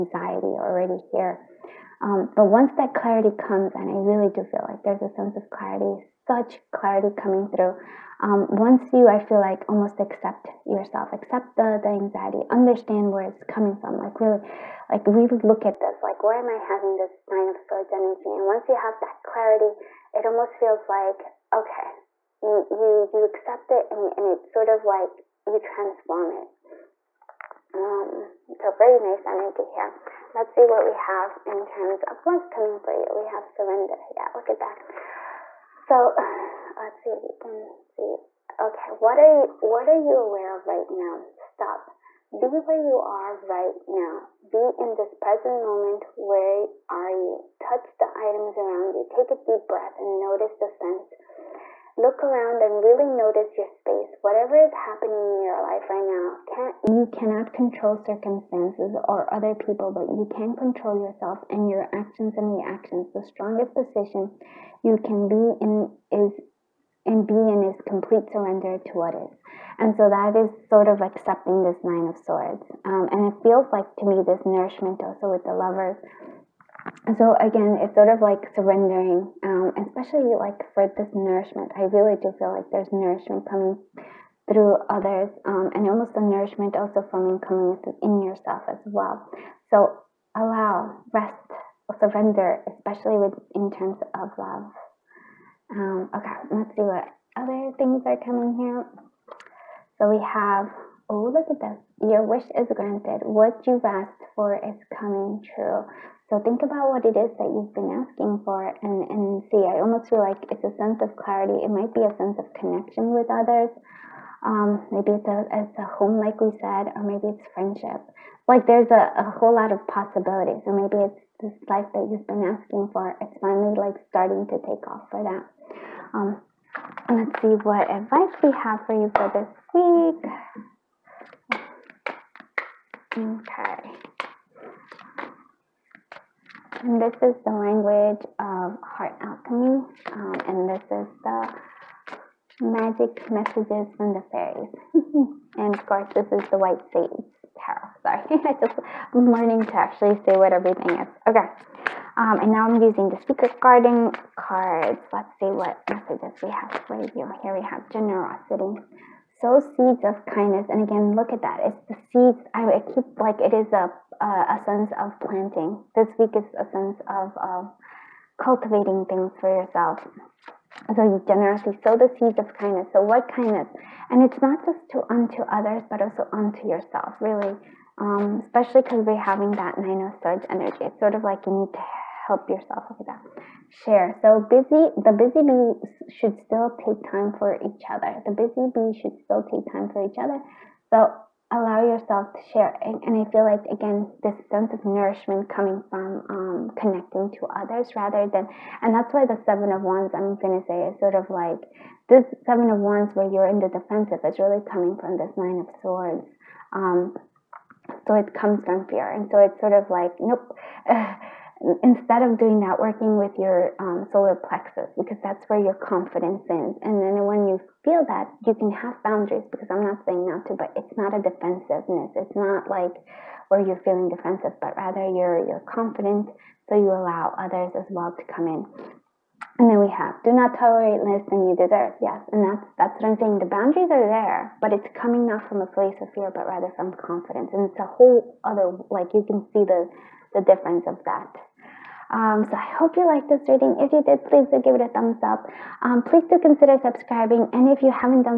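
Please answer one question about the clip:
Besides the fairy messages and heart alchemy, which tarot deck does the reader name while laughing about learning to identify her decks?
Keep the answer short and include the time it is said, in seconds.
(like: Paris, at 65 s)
White Sage Tarot, at 146 s.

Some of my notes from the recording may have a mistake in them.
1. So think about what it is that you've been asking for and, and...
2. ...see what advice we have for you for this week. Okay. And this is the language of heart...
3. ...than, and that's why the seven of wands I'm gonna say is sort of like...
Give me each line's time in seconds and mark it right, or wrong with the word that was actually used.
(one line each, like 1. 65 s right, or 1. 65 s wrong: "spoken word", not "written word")
1. 106 s right
2. 127 s right
3. 198 s right.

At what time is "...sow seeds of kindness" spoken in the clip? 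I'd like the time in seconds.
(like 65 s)
159 s.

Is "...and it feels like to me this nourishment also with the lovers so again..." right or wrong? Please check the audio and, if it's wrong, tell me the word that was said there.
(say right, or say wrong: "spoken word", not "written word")
right.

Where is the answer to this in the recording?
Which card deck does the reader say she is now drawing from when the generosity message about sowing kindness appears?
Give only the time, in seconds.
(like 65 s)
153 s.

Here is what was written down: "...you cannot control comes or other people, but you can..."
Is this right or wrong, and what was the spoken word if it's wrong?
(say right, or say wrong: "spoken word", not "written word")
wrong: "circumstances", not "comes".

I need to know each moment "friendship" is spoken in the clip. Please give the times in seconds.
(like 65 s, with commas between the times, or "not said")
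117 s.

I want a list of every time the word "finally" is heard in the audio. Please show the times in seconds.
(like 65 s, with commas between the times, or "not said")
123 s.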